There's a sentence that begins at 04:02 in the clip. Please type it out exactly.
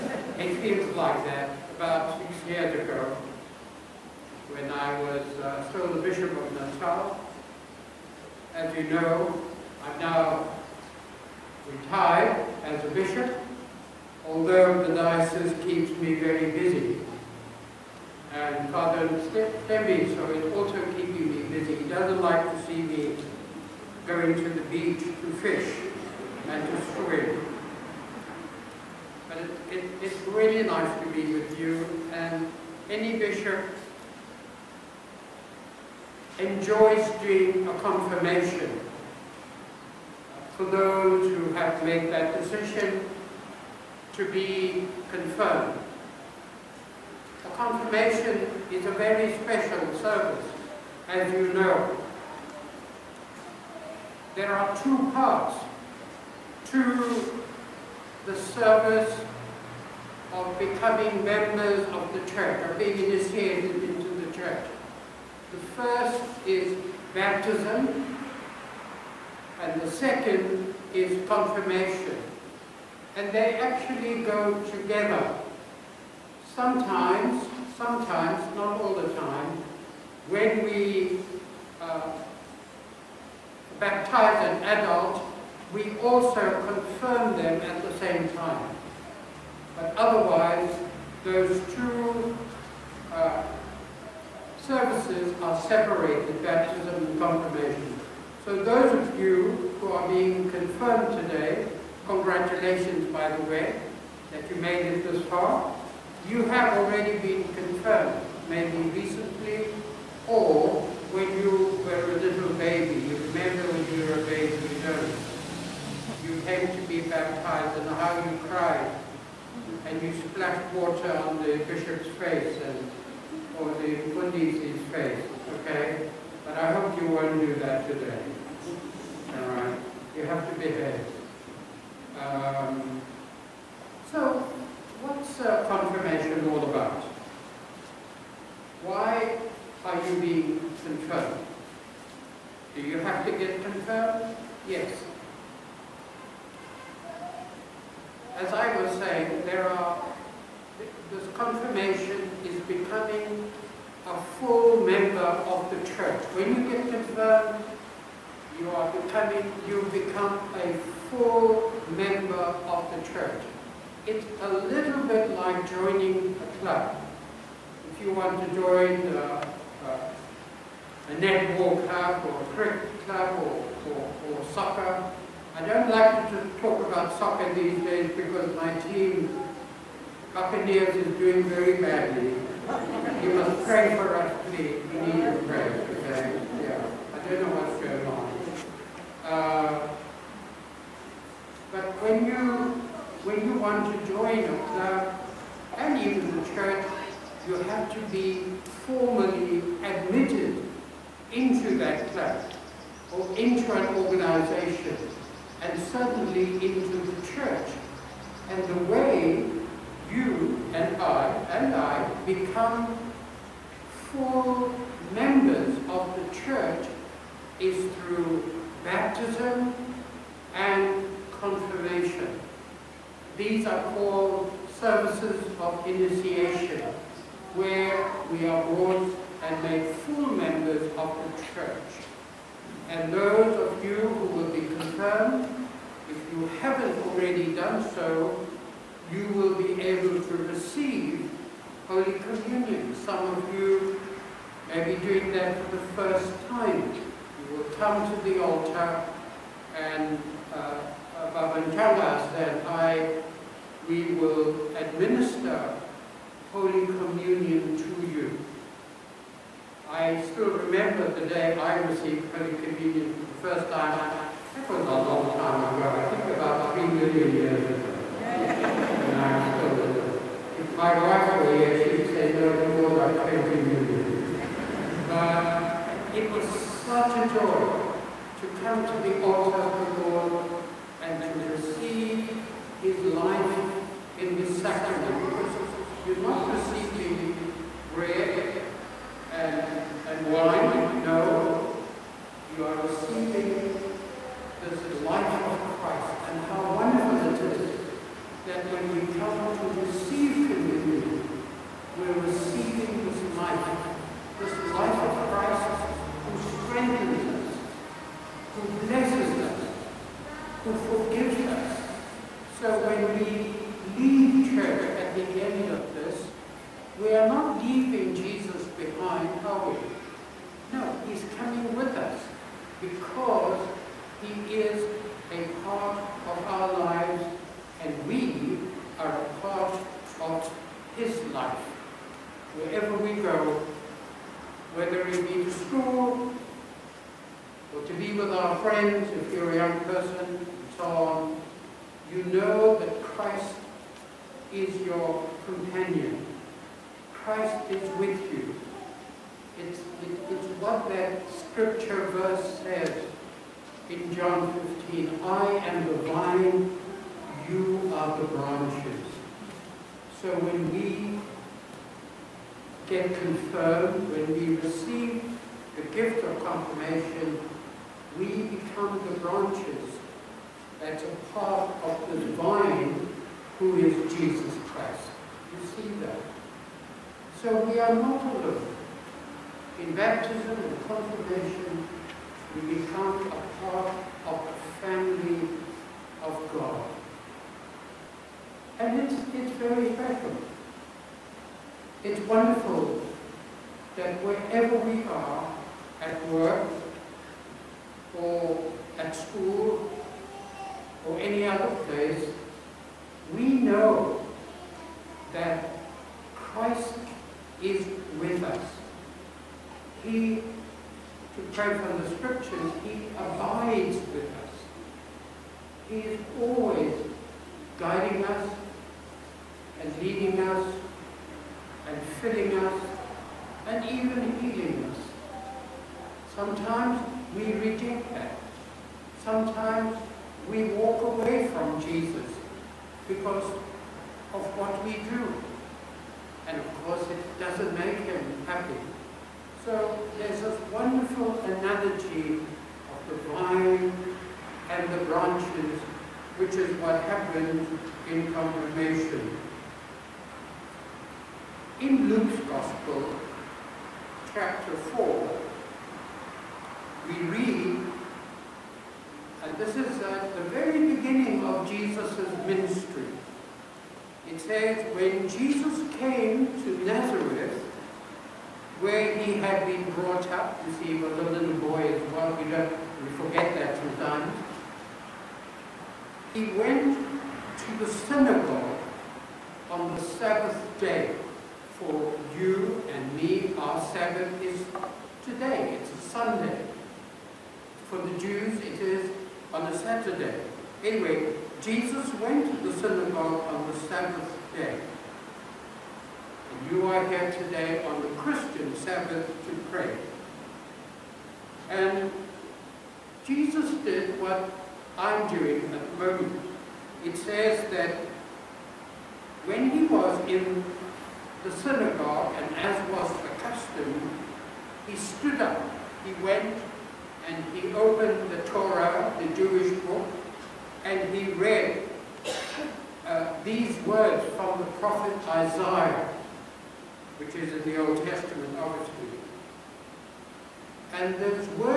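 Some of you may be doing that for the first time.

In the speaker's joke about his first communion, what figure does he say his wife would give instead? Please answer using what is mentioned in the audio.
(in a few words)
20 million.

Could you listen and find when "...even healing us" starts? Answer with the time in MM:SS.
07:03.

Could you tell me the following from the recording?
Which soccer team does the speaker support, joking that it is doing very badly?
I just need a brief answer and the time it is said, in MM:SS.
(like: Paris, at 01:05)
Buccaneers, at 03:00.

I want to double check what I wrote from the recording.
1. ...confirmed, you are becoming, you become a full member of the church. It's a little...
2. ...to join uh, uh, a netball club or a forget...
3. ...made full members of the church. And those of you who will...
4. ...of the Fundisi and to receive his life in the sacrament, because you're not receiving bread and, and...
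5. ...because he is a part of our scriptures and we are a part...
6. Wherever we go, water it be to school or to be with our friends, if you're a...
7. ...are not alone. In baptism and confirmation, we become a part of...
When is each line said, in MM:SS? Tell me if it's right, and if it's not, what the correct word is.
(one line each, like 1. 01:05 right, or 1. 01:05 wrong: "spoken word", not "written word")
1. 02:36 right
2. 02:48 wrong: "cricket", not "forget"
3. 03:49 right
4. 04:39 wrong: "Lord", not "Fundisi"
5. 05:22 wrong: "lives", not "scriptures"
6. 05:32 wrong: "whether", not "water"
7. 06:17 right.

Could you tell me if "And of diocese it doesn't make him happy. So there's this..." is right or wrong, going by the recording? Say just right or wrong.
wrong.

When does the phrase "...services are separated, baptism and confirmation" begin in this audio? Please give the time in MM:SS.
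01:34.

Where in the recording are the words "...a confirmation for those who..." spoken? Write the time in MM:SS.
00:37.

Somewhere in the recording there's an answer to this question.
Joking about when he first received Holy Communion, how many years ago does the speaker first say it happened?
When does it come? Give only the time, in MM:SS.
04:26.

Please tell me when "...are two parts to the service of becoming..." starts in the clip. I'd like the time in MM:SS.
00:54.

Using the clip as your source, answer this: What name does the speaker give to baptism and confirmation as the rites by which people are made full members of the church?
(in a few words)
services of initiation.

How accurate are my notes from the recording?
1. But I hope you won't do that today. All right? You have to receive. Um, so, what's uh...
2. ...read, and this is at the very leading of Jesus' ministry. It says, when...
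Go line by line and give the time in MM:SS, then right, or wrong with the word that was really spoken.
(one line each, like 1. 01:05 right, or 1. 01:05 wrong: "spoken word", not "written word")
1. 02:06 wrong: "behave", not "receive"
2. 07:37 wrong: "beginning", not "leading".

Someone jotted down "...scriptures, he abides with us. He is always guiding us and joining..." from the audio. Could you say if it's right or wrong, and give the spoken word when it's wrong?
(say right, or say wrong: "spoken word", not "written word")
wrong: "leading", not "joining".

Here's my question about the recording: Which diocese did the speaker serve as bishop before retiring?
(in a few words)
Natal.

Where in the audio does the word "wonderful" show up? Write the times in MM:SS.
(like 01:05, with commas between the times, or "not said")
04:56, 06:32, 07:20.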